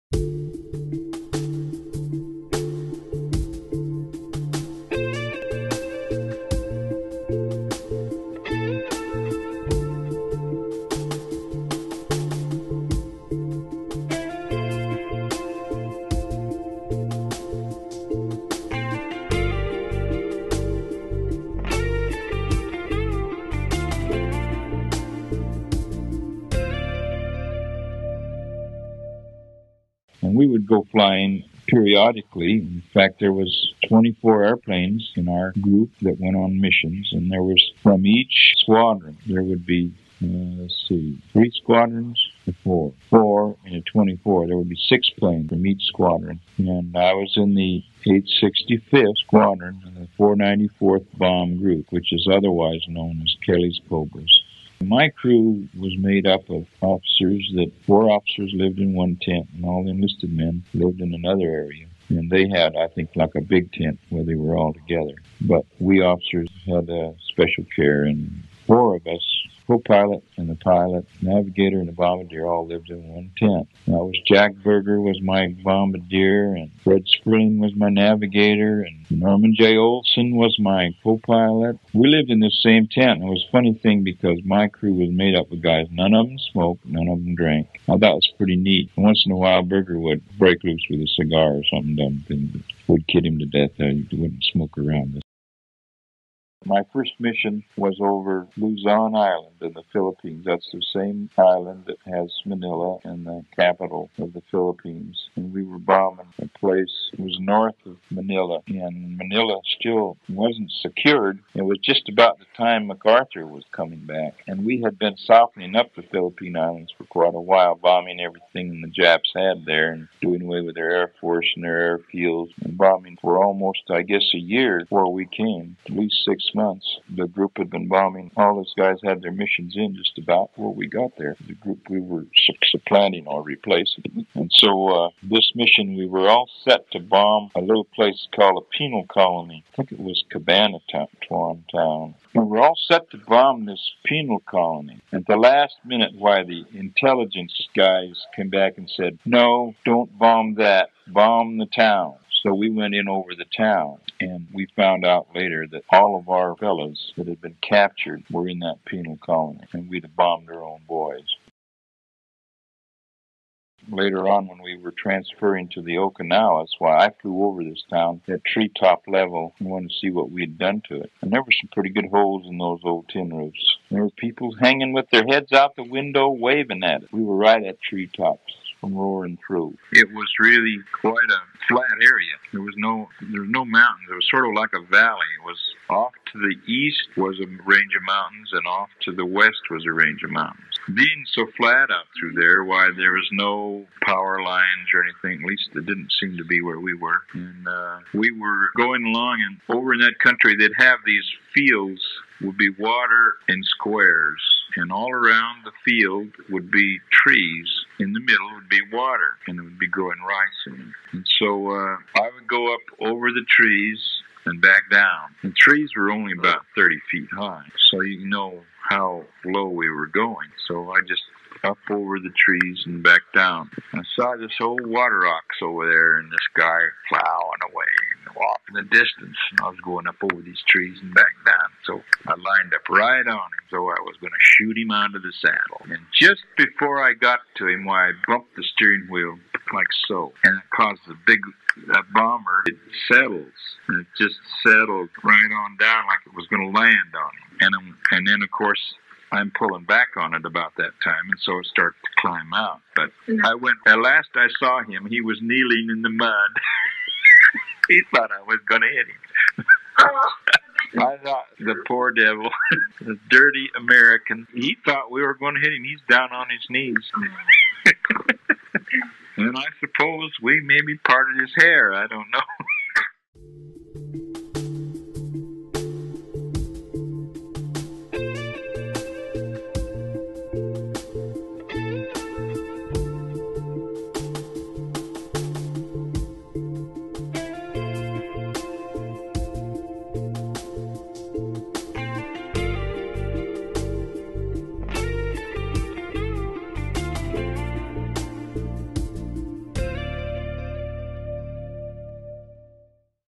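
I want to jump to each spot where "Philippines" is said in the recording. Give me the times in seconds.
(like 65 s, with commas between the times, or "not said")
99 s, 104 s, 116 s.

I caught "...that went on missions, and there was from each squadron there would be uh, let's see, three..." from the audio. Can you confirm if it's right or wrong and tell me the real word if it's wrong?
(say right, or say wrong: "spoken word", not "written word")
right.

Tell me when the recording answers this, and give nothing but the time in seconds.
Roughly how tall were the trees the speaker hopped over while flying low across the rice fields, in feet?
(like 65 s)
216 s.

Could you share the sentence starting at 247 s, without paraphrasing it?
And I'm, and then of course I'm pulling back on it about that time, and so it starts to climb out.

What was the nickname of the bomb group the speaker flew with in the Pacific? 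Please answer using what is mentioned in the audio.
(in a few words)
Kelley's Kobras.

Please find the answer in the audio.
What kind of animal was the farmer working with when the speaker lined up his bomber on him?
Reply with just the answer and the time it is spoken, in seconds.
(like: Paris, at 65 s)
water ox, at 224 s.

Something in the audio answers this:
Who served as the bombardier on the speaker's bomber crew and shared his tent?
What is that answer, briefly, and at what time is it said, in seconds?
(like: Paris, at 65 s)
Jack Berger, at 74 s.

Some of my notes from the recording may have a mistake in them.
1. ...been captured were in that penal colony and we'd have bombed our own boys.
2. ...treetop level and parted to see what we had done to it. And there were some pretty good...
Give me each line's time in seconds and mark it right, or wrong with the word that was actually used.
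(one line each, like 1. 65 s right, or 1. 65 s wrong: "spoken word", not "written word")
1. 157 s right
2. 168 s wrong: "wanted", not "parted".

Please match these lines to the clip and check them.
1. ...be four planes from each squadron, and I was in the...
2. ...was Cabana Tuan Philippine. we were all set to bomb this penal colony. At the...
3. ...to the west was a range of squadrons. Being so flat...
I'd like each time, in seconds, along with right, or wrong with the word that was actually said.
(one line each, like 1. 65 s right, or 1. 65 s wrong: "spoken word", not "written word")
1. 44 s wrong: "six", not "four"
2. 139 s wrong: "Town", not "Philippine"
3. 189 s wrong: "mountains", not "squadrons".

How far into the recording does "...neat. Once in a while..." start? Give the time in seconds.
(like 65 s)
88 s.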